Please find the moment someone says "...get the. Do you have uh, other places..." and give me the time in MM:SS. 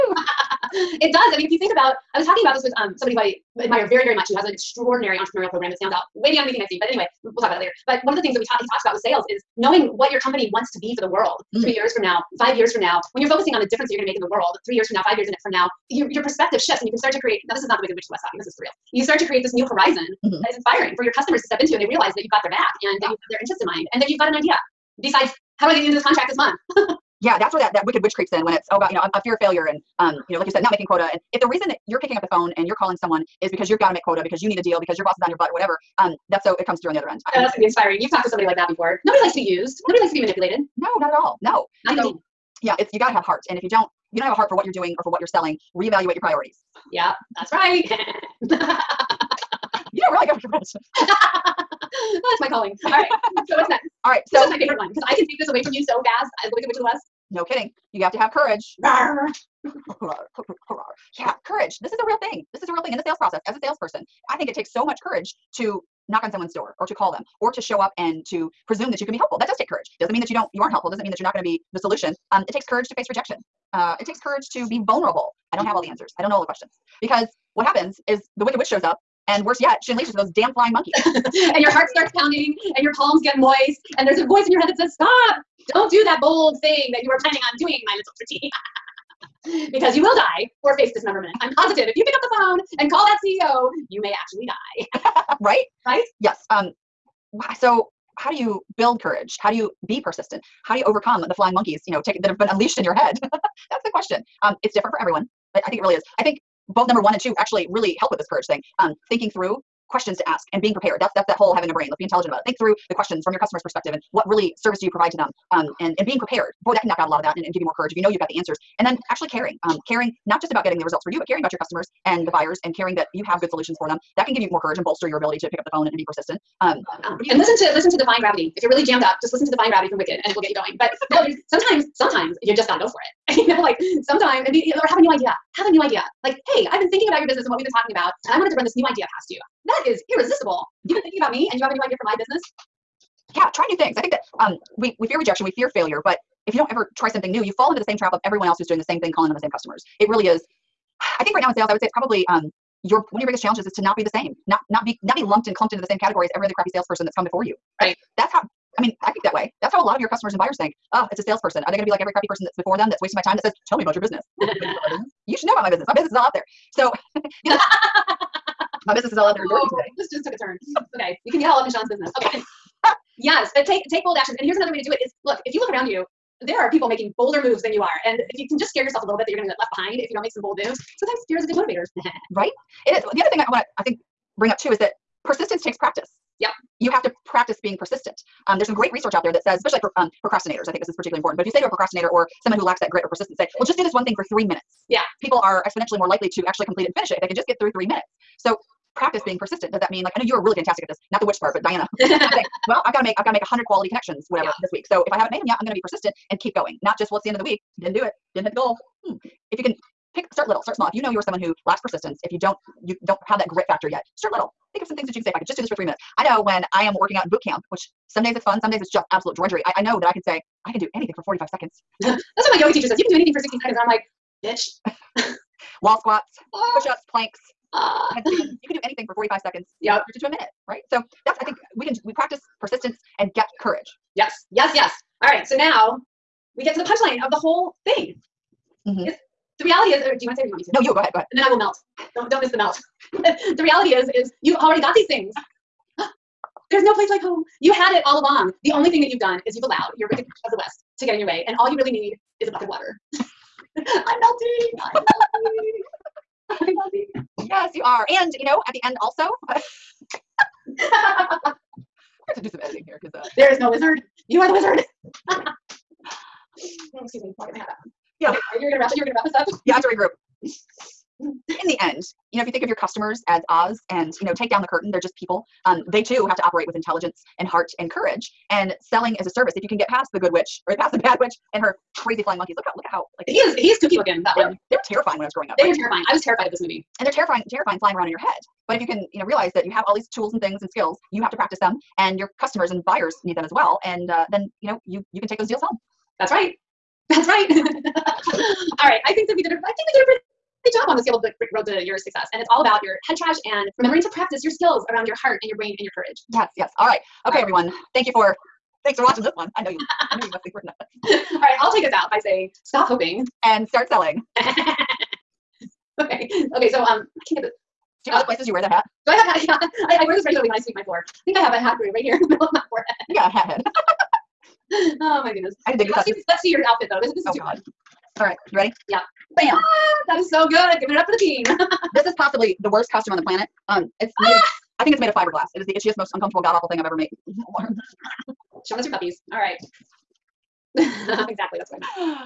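05:17.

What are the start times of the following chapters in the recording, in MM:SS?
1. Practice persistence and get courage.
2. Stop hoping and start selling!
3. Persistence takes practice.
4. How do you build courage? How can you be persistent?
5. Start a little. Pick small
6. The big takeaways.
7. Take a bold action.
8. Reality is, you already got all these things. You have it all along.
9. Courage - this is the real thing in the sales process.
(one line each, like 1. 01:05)
1. 03:53
2. 05:13
3. 03:05
4. 01:38
5. 03:30
6. 04:31
7. 02:53
8. 04:05
9. 00:58.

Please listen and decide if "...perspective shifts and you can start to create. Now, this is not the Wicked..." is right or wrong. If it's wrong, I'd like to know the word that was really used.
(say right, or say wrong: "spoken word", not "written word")
right.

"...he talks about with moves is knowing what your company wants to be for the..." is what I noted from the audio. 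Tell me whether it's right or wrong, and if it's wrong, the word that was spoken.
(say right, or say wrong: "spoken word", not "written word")
wrong: "sales", not "moves".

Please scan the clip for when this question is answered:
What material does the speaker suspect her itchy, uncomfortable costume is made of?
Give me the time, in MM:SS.
05:35.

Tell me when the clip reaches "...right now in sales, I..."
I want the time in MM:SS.
02:31.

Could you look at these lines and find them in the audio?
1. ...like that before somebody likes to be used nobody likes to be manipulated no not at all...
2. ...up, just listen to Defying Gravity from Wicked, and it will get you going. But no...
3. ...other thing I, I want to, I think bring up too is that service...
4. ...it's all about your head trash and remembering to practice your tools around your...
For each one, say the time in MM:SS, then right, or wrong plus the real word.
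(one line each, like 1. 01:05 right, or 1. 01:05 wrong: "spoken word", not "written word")
1. 00:38 wrong: "nobody", not "somebody"
2. 02:09 right
3. 03:03 wrong: "persistence", not "service"
4. 05:02 wrong: "skills", not "tools".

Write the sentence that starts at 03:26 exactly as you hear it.
Not just well, it's the end of the week, didn't do it, didn't hit the goal.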